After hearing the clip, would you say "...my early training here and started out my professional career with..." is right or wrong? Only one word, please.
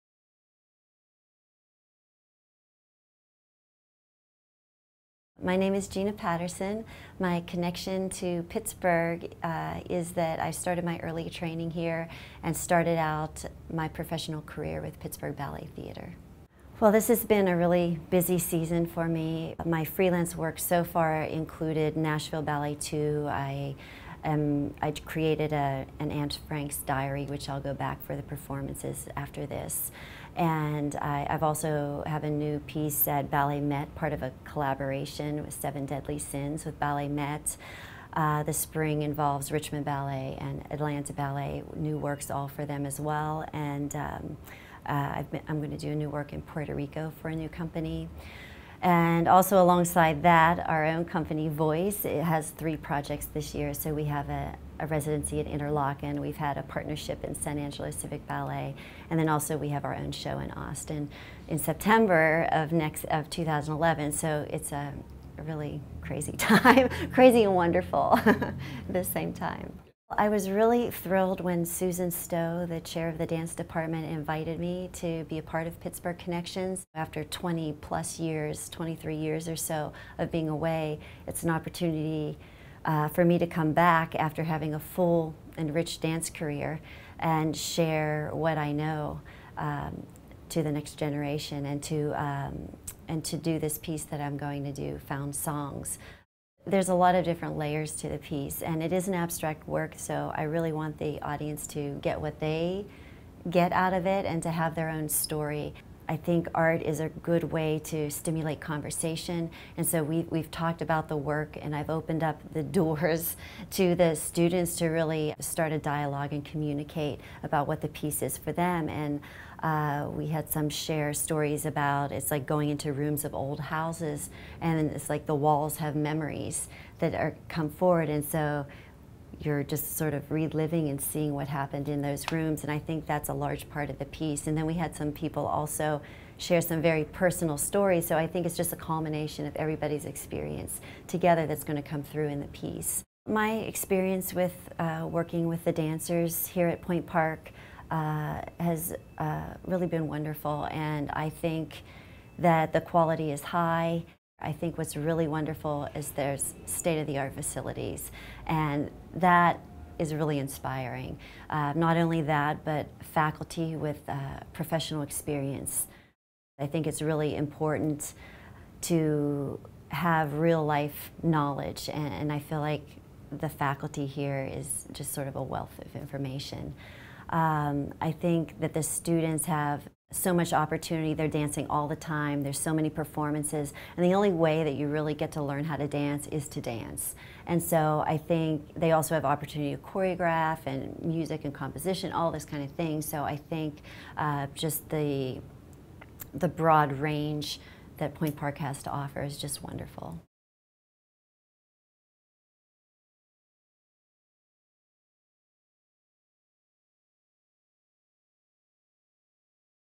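right.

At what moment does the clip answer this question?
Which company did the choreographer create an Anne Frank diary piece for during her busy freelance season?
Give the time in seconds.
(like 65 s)
21 s.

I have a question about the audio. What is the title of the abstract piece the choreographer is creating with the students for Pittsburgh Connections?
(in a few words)
Found Songs.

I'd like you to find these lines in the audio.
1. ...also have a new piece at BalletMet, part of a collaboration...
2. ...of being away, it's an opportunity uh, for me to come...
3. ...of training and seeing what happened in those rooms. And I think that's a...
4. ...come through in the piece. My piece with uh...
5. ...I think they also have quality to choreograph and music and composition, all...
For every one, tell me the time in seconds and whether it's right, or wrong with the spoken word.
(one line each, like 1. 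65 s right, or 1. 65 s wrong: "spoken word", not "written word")
1. 31 s right
2. 80 s right
3. 130 s wrong: "reliving", not "training"
4. 141 s wrong: "experience", not "piece"
5. 188 s wrong: "opportunity", not "quality".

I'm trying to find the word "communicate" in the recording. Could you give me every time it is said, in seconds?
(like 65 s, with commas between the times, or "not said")
116 s.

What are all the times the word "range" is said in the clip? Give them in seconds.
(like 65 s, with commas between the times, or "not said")
196 s.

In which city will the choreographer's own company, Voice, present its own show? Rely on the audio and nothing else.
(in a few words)
Austin.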